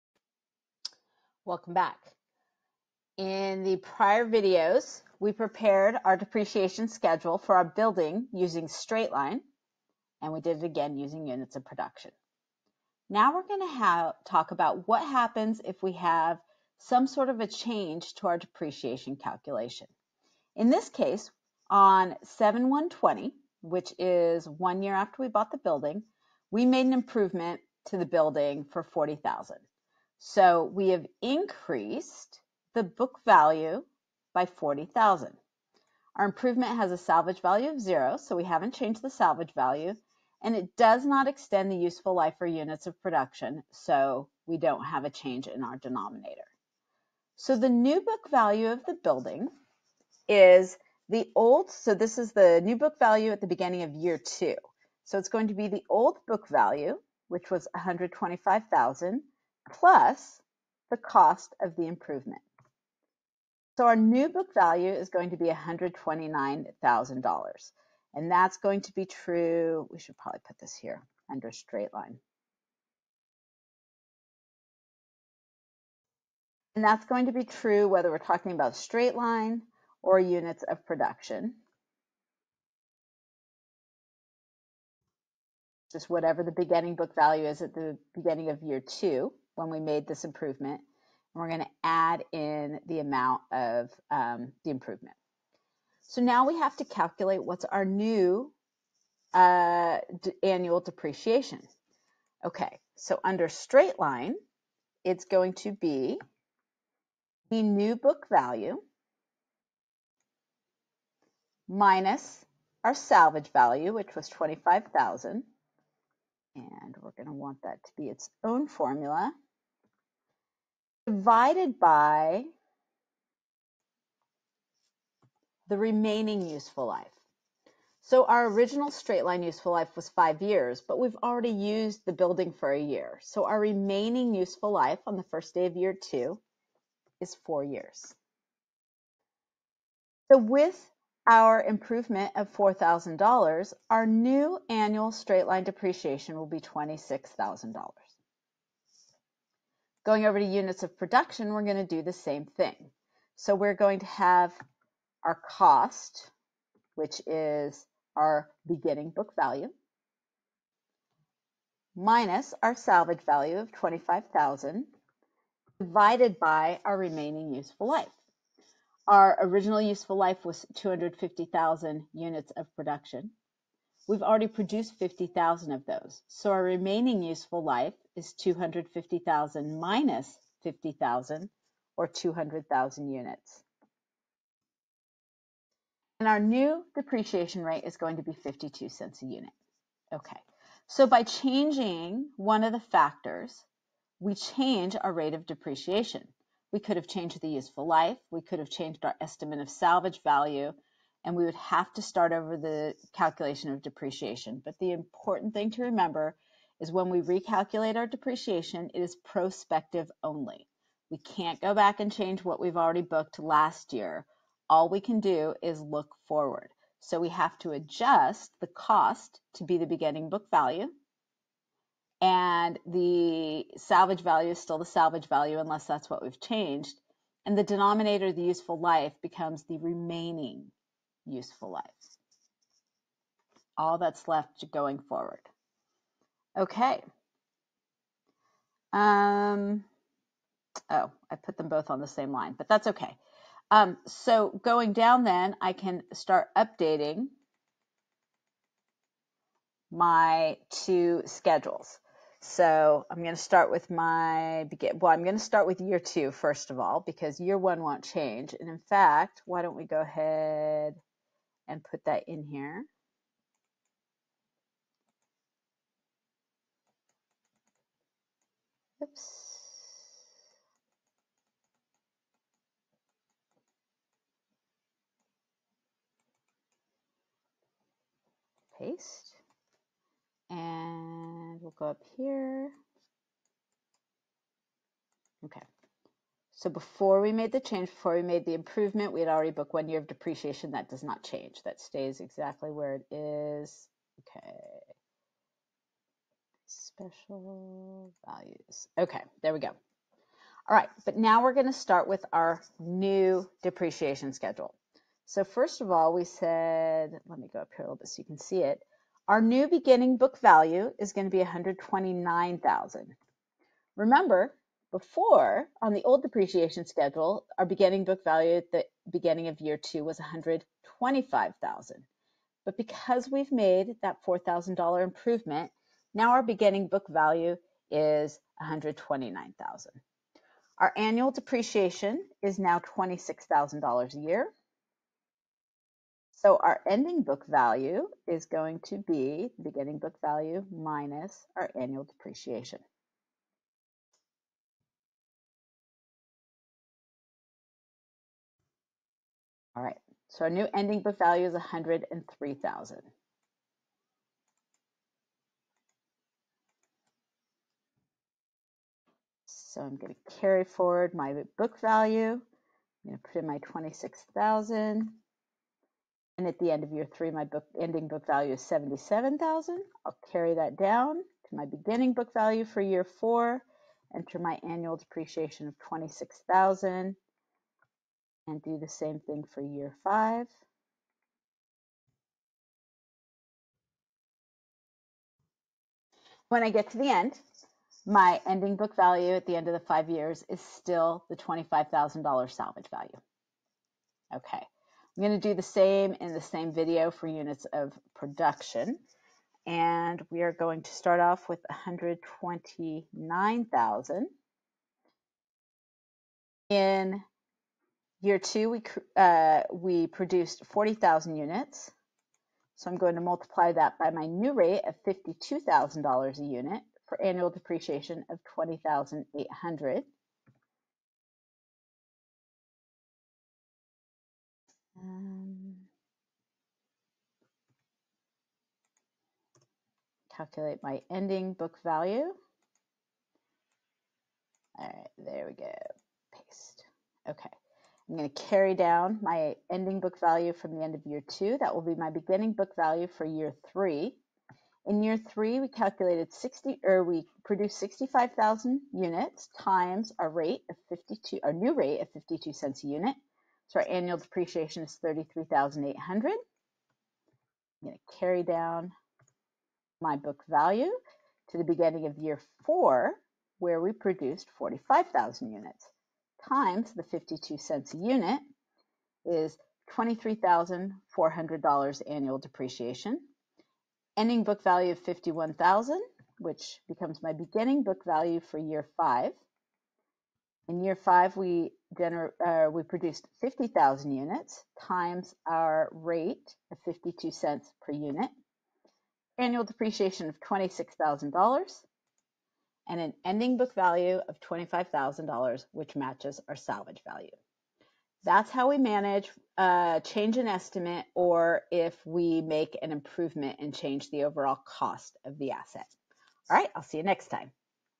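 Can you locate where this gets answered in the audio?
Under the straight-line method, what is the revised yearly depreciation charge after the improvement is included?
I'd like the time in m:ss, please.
2:26.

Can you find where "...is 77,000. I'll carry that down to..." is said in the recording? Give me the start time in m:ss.
6:08.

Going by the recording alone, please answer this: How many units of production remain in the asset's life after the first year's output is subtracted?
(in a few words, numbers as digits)
200,000 units.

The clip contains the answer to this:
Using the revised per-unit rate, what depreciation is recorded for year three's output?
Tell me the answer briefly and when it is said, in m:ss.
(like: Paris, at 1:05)
$33,800, at 7:35.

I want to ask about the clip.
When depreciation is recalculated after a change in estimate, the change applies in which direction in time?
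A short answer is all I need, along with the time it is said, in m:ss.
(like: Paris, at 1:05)
Prospective only, at 3:29.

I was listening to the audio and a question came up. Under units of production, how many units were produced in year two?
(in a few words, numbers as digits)
40,000 units.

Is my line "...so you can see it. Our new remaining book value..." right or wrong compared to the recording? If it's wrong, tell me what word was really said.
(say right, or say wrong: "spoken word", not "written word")
wrong: "beginning", not "remaining".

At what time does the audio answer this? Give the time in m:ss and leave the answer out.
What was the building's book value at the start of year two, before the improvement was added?
0:57.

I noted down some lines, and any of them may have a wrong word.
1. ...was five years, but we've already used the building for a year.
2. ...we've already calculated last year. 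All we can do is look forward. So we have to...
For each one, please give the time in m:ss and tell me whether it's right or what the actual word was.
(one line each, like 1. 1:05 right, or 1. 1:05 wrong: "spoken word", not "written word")
1. 2:09 right
2. 3:32 wrong: "booked", not "calculated".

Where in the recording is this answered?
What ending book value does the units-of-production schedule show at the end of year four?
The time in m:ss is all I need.
7:54.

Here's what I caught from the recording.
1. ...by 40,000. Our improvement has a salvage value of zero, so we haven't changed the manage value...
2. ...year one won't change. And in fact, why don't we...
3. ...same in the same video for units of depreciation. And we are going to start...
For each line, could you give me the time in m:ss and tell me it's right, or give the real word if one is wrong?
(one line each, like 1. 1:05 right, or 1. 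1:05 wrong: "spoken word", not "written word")
1. 0:34 wrong: "salvage", not "manage"
2. 4:17 right
3. 6:35 wrong: "production", not "depreciation".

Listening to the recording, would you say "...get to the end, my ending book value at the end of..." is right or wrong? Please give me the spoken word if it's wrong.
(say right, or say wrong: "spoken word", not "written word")
right.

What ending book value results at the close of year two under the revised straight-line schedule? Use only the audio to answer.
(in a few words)
$103,000.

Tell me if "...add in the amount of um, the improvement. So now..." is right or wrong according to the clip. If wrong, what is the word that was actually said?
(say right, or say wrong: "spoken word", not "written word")
right.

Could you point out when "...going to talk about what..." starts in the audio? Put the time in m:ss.
0:13.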